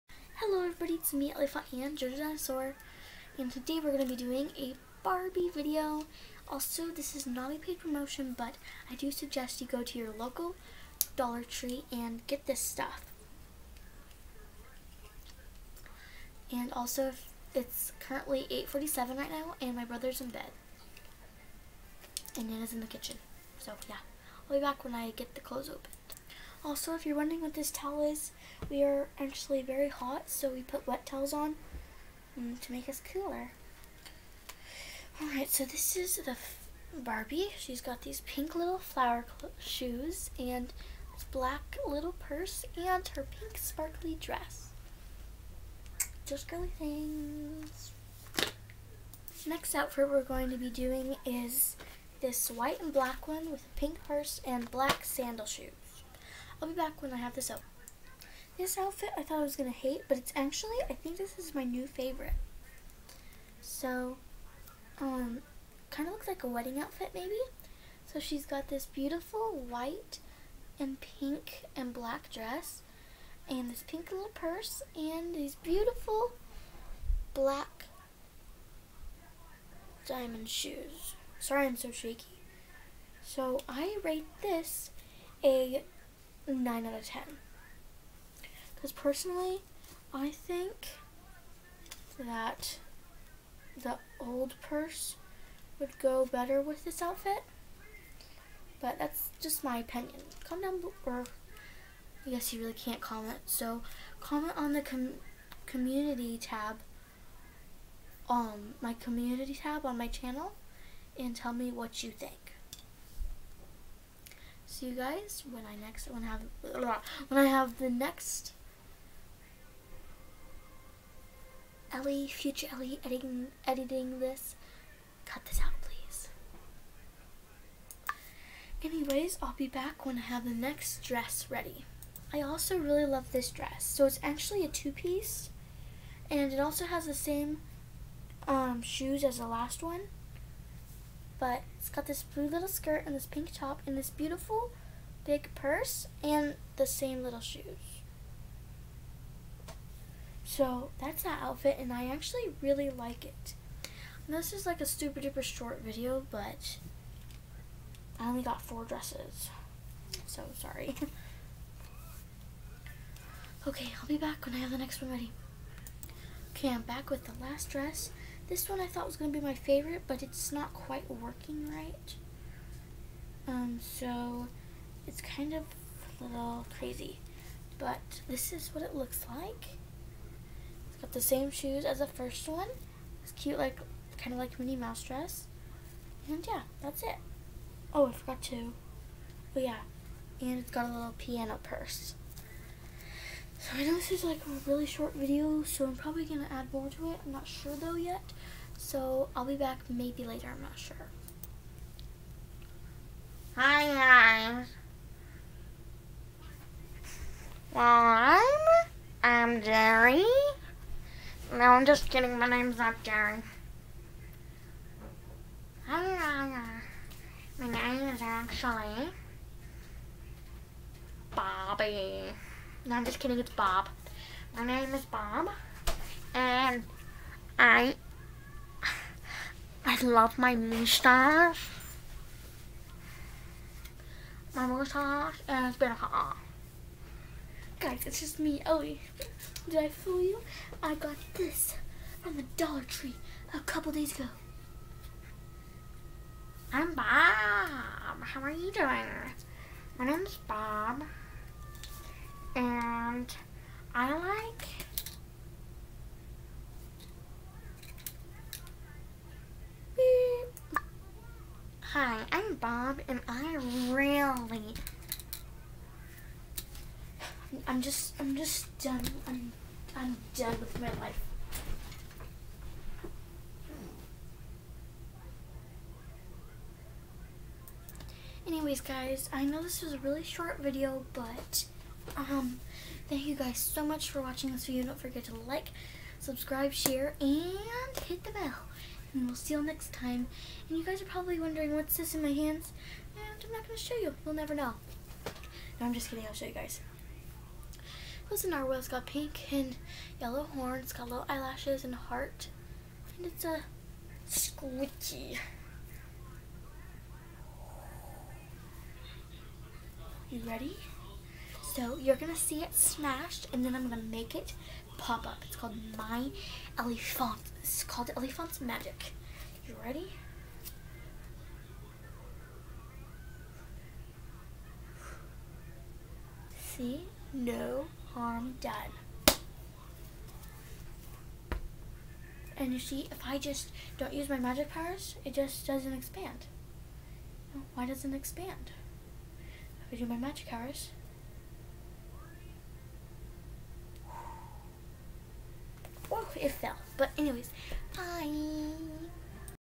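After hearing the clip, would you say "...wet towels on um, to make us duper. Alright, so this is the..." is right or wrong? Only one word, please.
wrong.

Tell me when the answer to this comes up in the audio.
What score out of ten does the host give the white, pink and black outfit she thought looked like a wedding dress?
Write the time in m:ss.
1:26.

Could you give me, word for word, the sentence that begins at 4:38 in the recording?
Anyways guys, I know this was a really short video, but um Thank you guys so much for watching this video.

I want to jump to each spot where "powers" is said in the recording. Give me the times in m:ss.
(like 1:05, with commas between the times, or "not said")
5:34, 5:40.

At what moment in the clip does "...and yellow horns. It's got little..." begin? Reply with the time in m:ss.
4:59.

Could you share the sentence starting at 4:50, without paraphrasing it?
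And you guys are probably wondering, what's this in my hands?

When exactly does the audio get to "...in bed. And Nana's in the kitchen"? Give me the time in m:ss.
0:20.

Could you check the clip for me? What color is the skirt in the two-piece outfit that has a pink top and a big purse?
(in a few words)
Blue.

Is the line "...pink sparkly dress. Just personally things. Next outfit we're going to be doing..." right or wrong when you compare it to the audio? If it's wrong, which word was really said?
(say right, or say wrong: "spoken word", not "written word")
wrong: "girly", not "personally".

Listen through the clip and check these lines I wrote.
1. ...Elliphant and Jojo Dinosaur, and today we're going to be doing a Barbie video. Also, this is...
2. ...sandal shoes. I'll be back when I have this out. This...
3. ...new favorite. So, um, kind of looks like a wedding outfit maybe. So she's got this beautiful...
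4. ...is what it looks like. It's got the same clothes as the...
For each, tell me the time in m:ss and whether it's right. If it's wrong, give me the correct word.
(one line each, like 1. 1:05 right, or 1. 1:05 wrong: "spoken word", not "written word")
1. 0:01 right
2. 0:55 right
3. 1:01 right
4. 2:58 wrong: "shoes", not "clothes".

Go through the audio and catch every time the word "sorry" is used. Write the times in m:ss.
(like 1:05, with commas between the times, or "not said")
1:21, 2:40.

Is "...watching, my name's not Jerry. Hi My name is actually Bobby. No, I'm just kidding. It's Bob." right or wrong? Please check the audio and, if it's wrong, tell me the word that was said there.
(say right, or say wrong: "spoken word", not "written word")
wrong: "kidding", not "watching".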